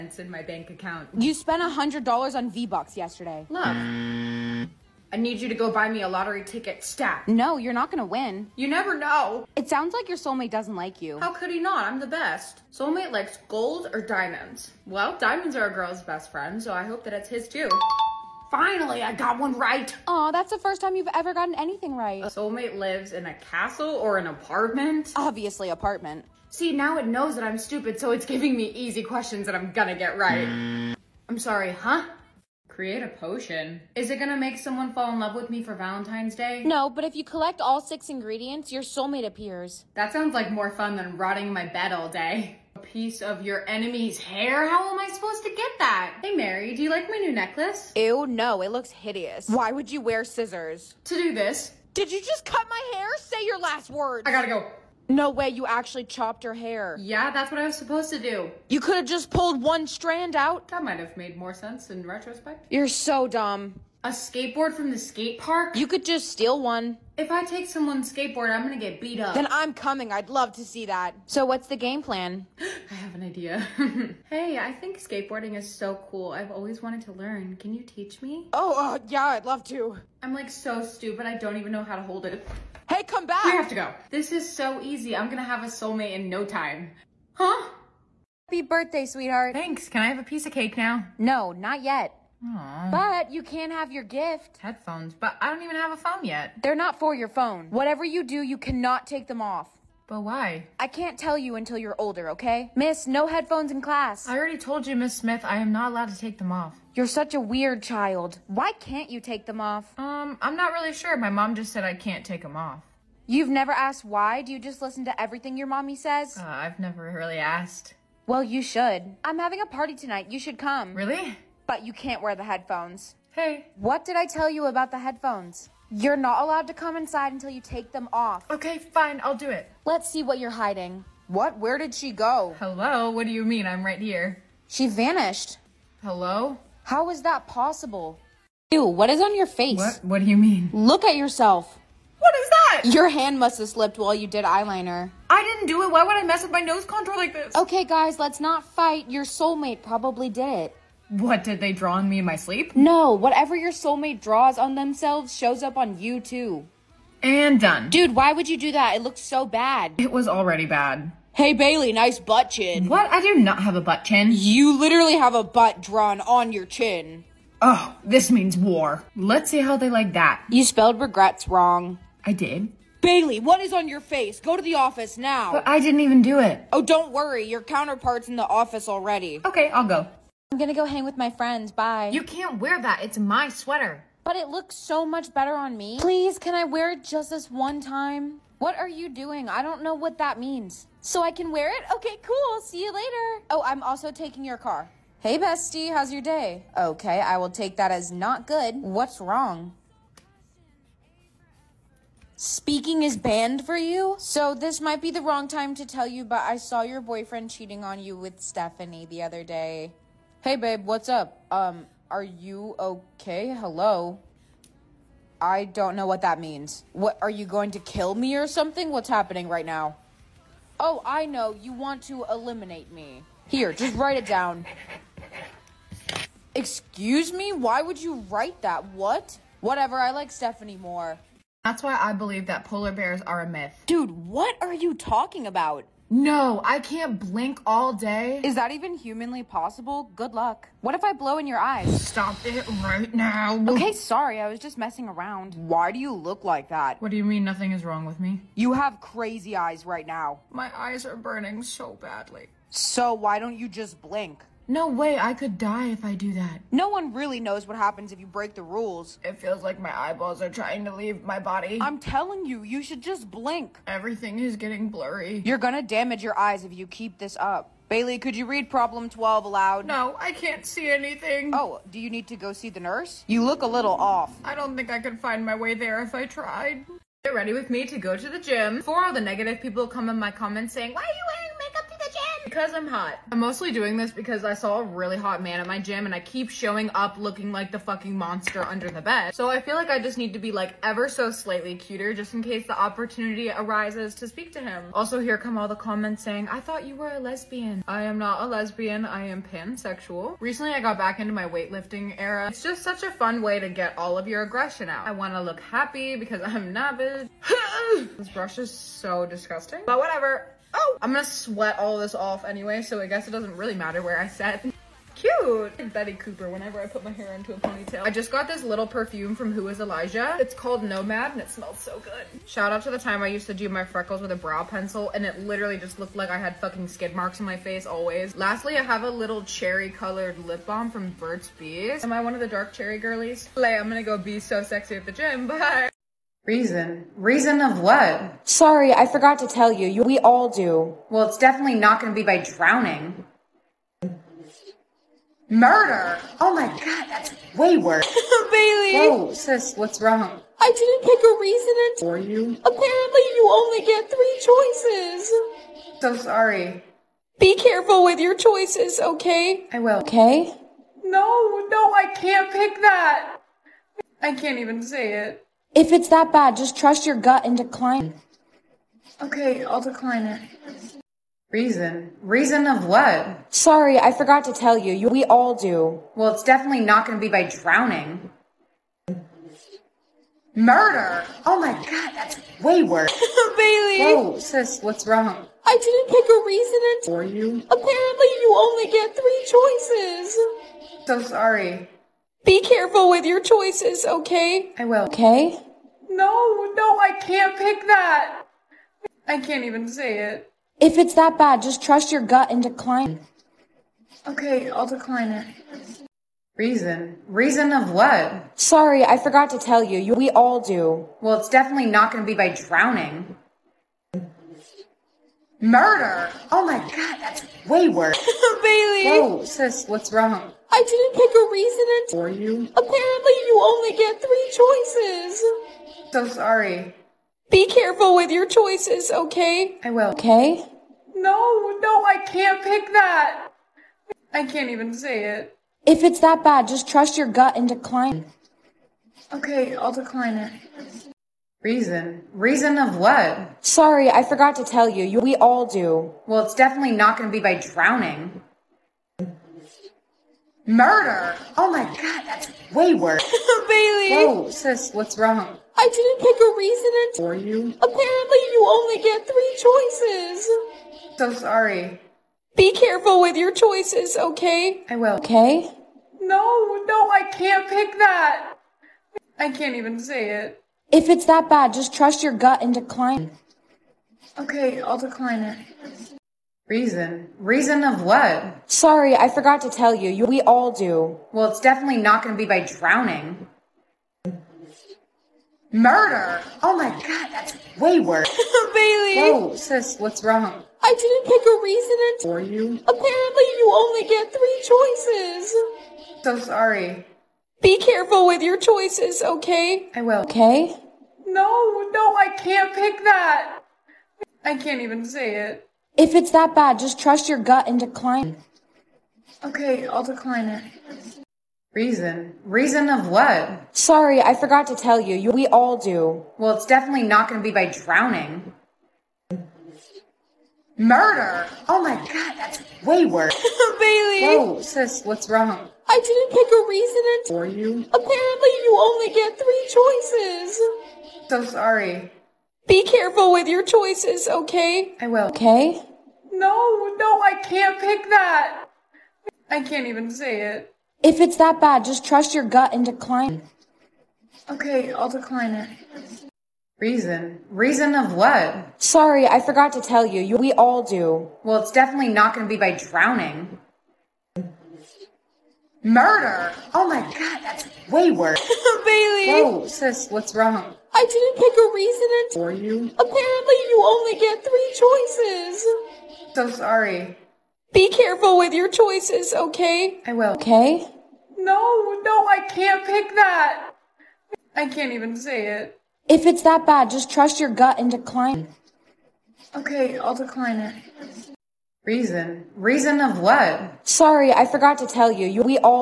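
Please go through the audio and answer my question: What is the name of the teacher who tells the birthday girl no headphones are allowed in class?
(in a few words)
Miss Smith.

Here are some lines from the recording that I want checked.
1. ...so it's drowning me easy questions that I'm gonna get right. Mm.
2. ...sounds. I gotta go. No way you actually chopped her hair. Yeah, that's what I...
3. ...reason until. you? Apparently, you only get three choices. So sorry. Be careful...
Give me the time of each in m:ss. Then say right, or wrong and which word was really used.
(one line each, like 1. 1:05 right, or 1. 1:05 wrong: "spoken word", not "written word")
1. 0:27 wrong: "giving", not "drowning"
2. 0:53 wrong: "words", not "sounds"
3. 5:51 right.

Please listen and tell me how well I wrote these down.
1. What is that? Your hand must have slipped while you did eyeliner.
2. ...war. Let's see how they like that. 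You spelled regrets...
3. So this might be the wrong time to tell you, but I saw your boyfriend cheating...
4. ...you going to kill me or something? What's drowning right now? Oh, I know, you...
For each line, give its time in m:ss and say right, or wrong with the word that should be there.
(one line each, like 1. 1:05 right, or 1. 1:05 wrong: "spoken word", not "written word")
1. 2:22 right
2. 2:48 right
3. 3:24 right
4. 3:37 wrong: "happening", not "drowning".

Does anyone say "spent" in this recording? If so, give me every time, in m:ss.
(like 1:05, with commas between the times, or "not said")
0:01.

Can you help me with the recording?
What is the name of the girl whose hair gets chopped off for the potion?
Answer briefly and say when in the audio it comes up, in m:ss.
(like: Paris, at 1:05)
Mary, at 0:46.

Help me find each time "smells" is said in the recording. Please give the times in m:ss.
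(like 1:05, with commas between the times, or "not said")
5:21.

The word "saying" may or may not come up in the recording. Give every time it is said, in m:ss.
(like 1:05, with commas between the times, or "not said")
4:40, 4:56.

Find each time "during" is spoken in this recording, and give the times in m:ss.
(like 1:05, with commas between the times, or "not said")
not said.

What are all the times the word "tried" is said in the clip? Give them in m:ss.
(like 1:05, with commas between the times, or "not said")
4:36.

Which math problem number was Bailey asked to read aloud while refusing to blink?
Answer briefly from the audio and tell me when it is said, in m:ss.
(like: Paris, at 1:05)
12, at 4:29.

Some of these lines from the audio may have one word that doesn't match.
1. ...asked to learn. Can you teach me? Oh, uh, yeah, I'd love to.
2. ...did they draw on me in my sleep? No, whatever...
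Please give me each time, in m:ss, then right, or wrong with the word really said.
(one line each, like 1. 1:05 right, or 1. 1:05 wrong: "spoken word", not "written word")
1. 1:16 wrong: "wanted", not "asked"
2. 2:31 right.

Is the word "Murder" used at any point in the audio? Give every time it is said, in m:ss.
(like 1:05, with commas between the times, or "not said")
5:45, 6:20, 6:55, 7:30, 8:05, 8:40, 9:15.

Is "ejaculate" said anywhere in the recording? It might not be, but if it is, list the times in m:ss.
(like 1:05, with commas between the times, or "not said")
not said.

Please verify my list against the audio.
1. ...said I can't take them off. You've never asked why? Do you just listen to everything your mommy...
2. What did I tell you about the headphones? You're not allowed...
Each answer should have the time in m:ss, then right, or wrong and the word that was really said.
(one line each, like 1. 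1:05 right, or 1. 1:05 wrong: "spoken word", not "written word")
1. 1:51 right
2. 2:03 right.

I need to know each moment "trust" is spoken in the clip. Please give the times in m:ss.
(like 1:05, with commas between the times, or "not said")
6:06, 6:41, 7:16, 7:51, 8:26, 9:02, 9:37.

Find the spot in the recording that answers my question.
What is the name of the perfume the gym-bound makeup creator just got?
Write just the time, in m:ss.
5:20.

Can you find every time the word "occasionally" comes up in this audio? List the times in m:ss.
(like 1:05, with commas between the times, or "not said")
not said.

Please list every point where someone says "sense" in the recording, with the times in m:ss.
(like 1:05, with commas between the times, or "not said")
1:01.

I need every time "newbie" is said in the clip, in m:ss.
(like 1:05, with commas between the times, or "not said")
not said.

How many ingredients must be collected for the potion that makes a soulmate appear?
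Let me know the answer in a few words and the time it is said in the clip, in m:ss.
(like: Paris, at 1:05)
6, at 0:37.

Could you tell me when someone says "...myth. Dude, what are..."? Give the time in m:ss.
3:53.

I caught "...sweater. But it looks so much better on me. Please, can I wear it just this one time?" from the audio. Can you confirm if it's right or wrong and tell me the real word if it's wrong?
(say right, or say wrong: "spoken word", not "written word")
right.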